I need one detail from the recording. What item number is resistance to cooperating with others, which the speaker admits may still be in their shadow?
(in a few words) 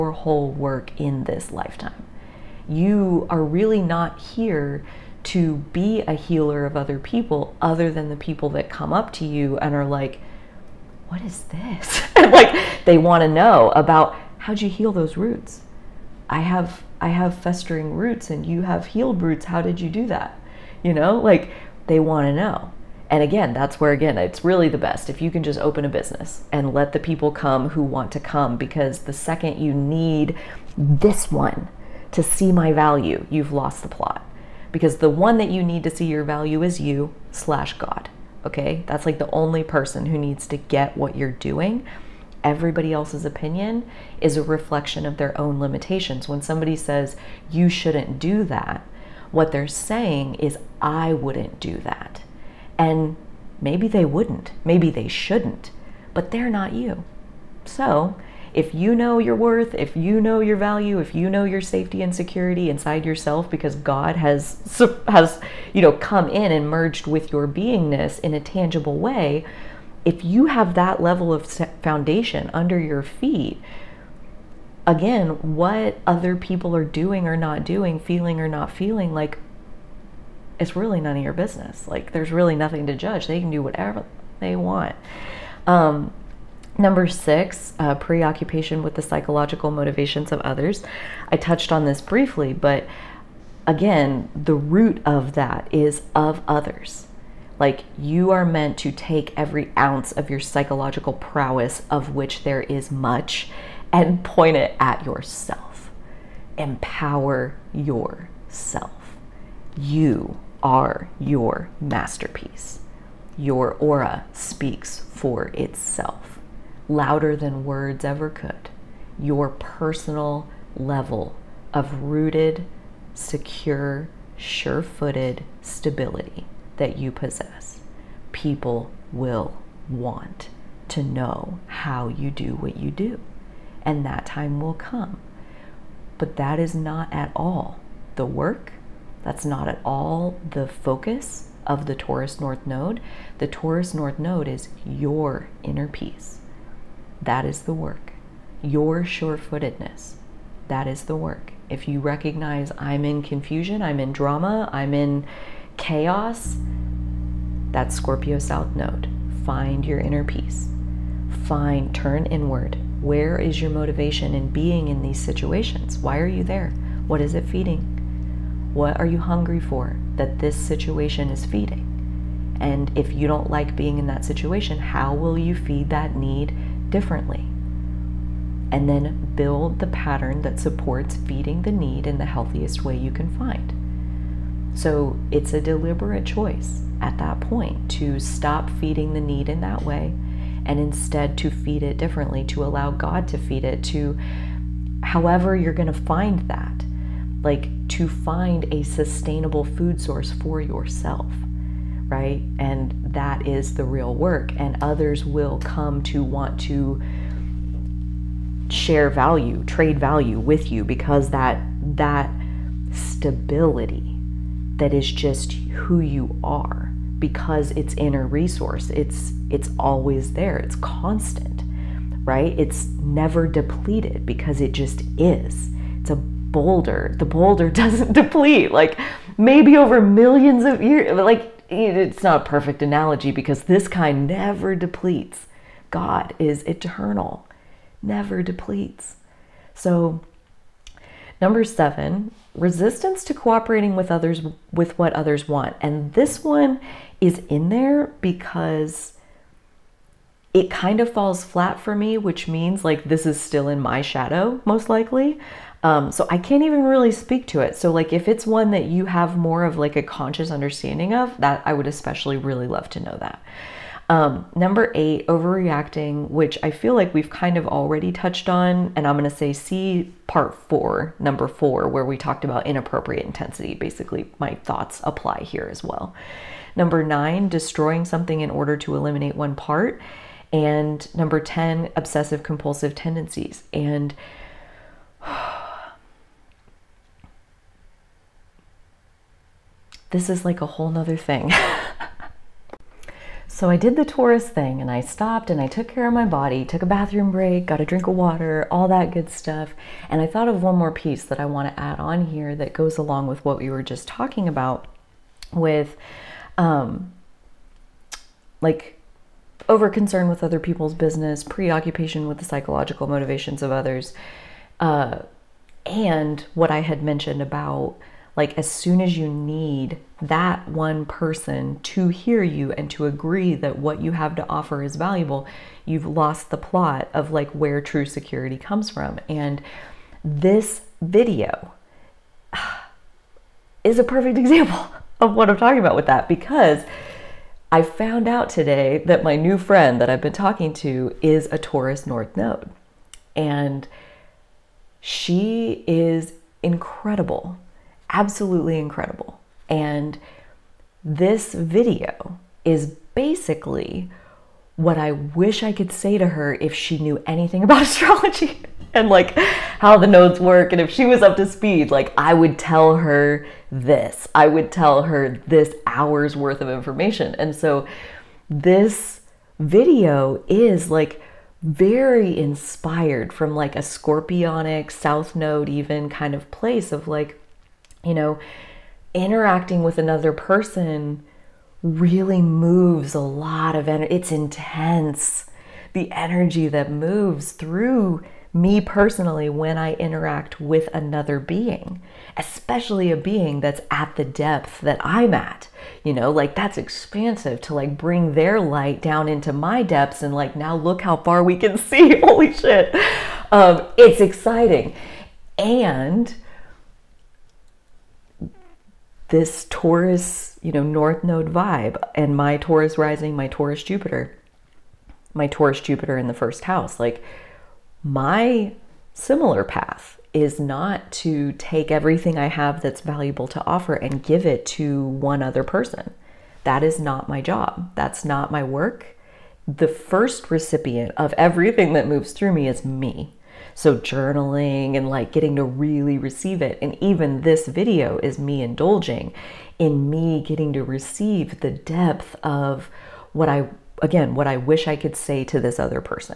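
7.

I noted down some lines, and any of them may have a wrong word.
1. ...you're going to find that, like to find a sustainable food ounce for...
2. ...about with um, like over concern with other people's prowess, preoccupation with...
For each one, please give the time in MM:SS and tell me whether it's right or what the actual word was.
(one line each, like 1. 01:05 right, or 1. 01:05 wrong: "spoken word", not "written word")
1. 03:15 wrong: "source", not "ounce"
2. 05:04 wrong: "business", not "prowess".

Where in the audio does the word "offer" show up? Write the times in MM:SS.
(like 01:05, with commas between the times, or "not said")
05:24, 07:03.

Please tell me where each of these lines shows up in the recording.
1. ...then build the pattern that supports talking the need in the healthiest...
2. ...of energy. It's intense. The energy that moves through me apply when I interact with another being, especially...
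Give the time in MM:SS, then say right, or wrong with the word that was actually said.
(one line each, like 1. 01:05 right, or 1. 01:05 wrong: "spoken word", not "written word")
1. 02:58 wrong: "feeding", not "talking"
2. 06:23 wrong: "personally", not "apply".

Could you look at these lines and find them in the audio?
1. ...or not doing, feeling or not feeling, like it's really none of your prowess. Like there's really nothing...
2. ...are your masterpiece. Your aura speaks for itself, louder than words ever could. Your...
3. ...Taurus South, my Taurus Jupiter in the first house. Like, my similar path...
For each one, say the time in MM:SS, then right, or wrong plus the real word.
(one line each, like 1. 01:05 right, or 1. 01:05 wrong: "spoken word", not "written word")
1. 01:17 wrong: "business", not "prowess"
2. 01:50 right
3. 06:53 wrong: "Jupiter", not "South".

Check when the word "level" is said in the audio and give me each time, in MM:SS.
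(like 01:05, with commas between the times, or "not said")
01:11, 02:00.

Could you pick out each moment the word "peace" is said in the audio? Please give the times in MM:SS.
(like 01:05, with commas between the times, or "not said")
02:25, 02:40.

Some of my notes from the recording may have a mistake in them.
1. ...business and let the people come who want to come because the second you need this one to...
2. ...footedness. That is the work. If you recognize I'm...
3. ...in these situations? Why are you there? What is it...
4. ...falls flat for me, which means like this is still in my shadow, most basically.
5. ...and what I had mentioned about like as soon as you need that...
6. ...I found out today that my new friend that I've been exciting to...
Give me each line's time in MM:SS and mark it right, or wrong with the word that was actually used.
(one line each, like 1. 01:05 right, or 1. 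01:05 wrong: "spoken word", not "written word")
1. 00:25 right
2. 02:29 right
3. 02:44 right
4. 04:11 wrong: "likely", not "basically"
5. 05:15 right
6. 05:37 wrong: "talking", not "exciting".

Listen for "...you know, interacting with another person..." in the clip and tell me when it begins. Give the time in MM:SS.
06:18.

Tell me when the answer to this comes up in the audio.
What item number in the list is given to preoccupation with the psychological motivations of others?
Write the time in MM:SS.
01:26.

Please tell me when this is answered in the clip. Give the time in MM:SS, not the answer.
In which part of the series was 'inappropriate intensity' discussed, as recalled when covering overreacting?
04:30.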